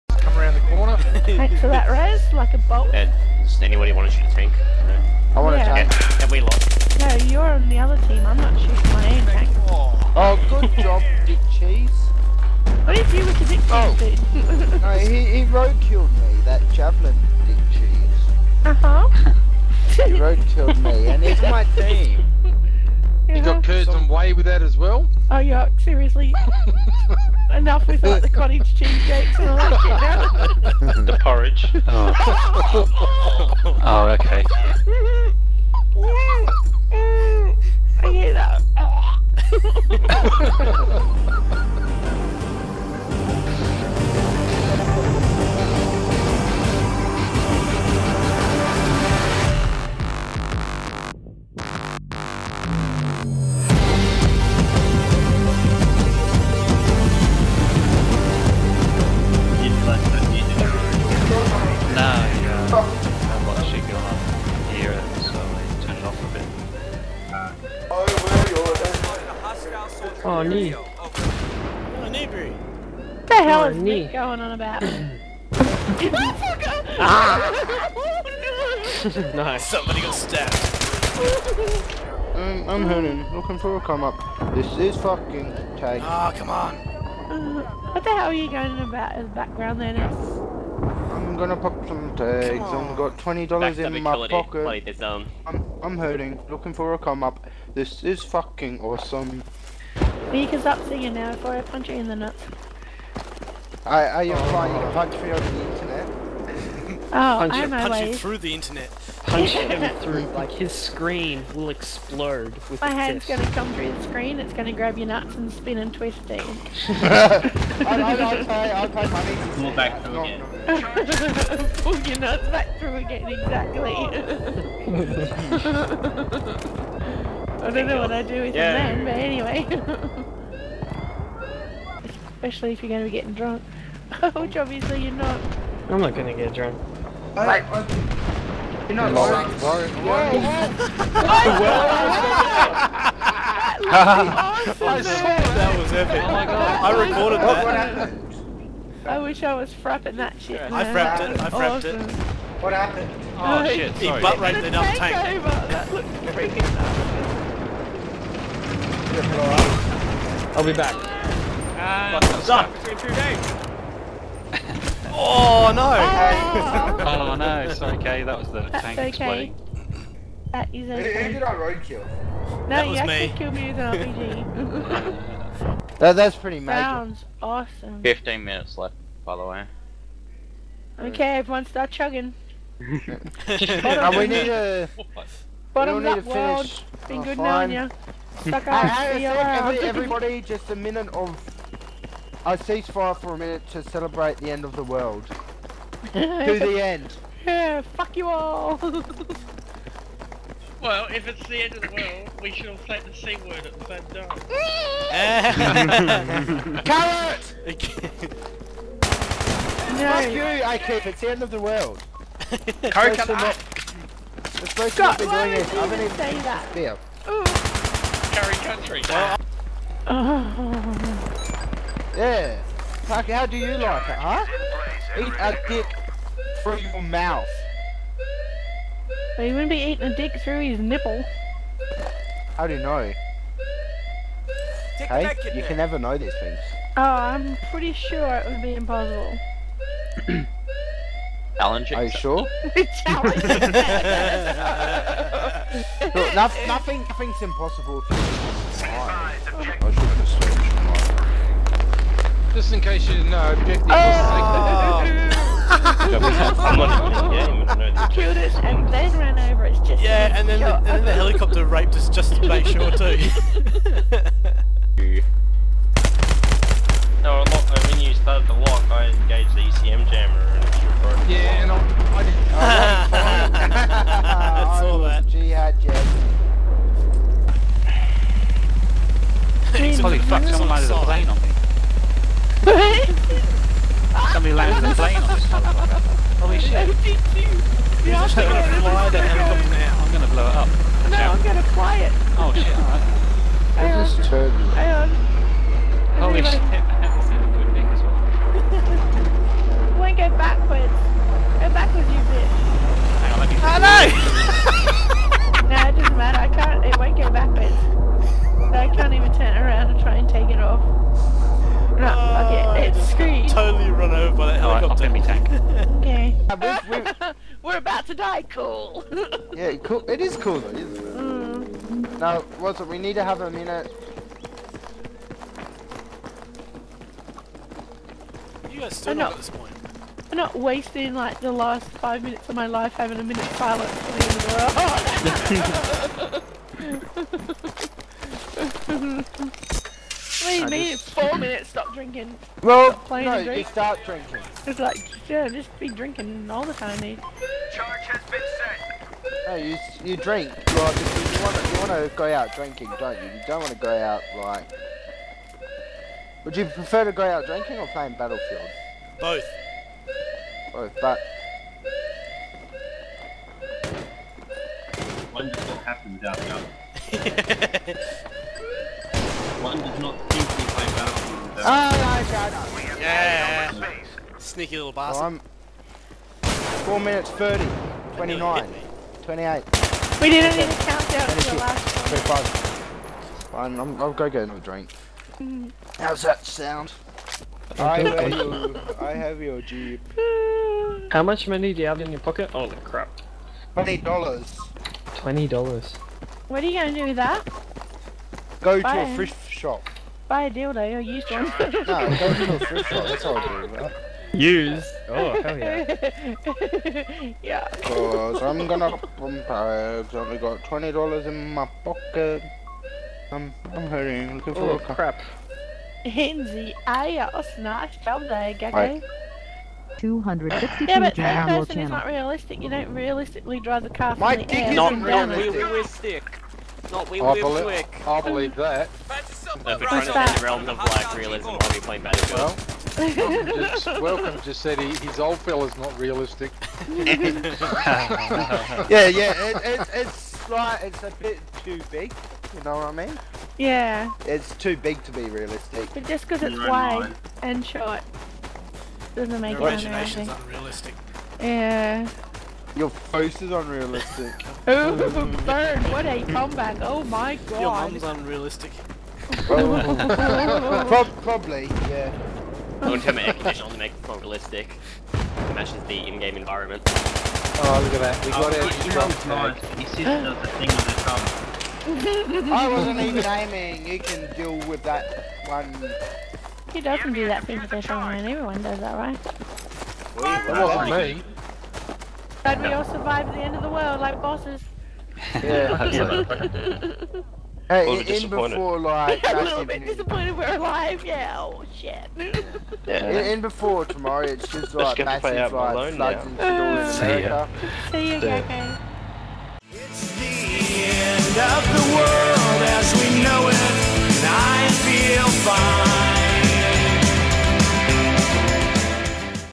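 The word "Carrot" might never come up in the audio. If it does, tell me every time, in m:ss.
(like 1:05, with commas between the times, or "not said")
3:26, 3:32.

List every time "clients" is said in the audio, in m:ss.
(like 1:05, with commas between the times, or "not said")
not said.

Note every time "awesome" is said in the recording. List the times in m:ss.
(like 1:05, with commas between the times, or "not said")
1:38, 2:31, 2:57.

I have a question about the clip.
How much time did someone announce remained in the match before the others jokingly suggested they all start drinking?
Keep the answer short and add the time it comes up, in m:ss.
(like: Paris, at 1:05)
15 minutes, at 2:58.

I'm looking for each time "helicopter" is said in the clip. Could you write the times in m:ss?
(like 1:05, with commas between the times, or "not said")
4:21, 4:49.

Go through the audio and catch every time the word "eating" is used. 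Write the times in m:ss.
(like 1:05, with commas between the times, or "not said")
3:49.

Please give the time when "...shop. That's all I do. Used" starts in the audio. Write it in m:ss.
6:42.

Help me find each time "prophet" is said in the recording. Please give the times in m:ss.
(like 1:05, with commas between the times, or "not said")
not said.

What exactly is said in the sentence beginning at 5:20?
It is cool though, isn't it?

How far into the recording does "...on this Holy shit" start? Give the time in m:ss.
4:45.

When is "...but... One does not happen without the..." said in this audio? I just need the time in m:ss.
6:01.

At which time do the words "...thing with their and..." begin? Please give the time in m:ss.
7:57.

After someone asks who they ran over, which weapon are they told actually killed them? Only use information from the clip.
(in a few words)
RPG.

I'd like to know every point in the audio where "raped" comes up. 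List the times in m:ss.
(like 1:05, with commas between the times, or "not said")
2:34, 4:21.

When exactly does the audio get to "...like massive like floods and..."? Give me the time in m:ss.
8:14.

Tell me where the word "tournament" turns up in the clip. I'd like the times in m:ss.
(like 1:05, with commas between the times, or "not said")
not said.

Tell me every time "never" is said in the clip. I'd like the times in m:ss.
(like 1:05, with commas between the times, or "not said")
3:55.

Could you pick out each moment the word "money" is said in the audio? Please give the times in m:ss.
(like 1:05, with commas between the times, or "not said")
1:59, 6:31.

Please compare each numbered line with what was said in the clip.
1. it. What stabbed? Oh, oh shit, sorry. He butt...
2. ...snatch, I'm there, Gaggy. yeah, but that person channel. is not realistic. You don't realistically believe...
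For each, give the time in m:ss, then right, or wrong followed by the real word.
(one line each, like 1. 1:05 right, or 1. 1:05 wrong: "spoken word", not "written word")
1. 2:32 wrong: "happened", not "stabbed"
2. 6:57 wrong: "drive", not "believe".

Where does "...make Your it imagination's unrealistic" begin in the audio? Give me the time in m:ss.
7:29.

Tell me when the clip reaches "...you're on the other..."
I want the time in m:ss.
0:07.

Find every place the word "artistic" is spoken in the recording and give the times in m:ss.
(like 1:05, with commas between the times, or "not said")
not said.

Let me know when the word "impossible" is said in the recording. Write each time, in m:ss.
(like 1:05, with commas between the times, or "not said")
3:58, 4:07.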